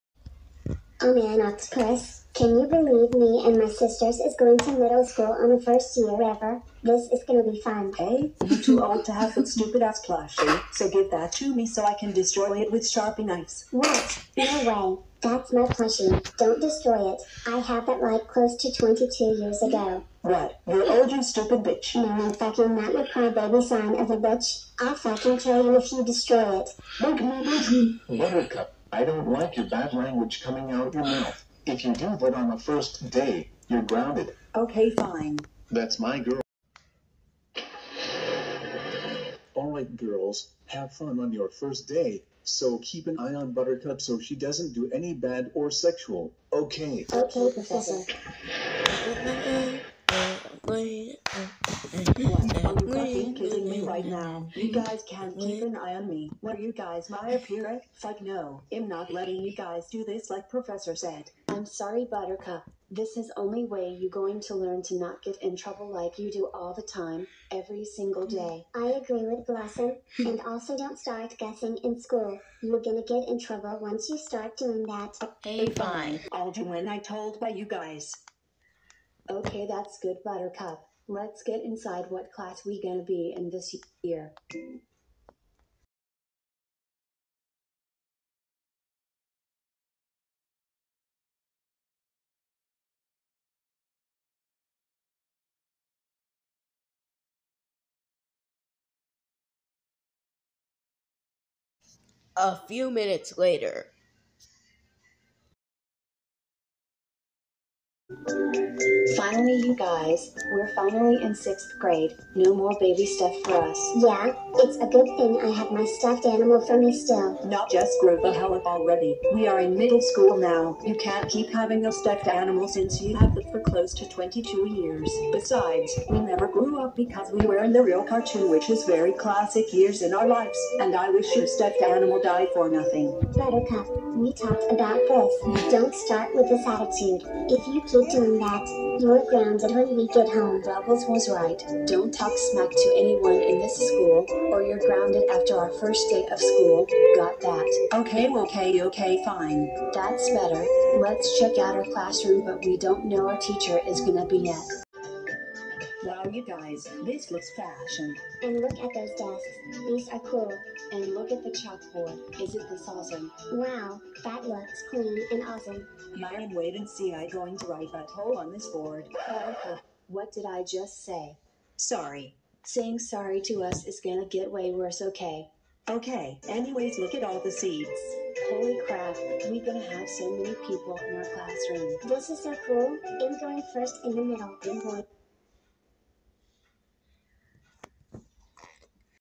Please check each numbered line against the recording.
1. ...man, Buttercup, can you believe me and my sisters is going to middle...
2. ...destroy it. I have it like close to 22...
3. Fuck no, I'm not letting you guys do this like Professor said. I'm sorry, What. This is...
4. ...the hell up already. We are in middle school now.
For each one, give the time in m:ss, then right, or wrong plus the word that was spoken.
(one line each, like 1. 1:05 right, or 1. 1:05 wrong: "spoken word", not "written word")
1. 0:01 wrong: "Octopus", not "Buttercup"
2. 0:16 right
3. 0:57 wrong: "Buttercup", not "What"
4. 1:58 right.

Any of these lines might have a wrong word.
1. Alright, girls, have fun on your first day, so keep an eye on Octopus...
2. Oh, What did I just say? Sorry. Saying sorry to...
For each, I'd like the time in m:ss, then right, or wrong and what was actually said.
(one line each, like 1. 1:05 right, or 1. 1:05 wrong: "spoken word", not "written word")
1. 0:39 wrong: "Buttercup", not "Octopus"
2. 2:49 right.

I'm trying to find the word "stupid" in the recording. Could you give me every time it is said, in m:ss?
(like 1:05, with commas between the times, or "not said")
0:09, 0:21.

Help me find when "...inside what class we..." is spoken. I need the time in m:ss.
1:21.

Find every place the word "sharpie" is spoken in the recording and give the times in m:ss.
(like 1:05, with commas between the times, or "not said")
0:12.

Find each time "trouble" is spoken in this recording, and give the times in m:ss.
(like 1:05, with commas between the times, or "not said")
1:05, 1:13.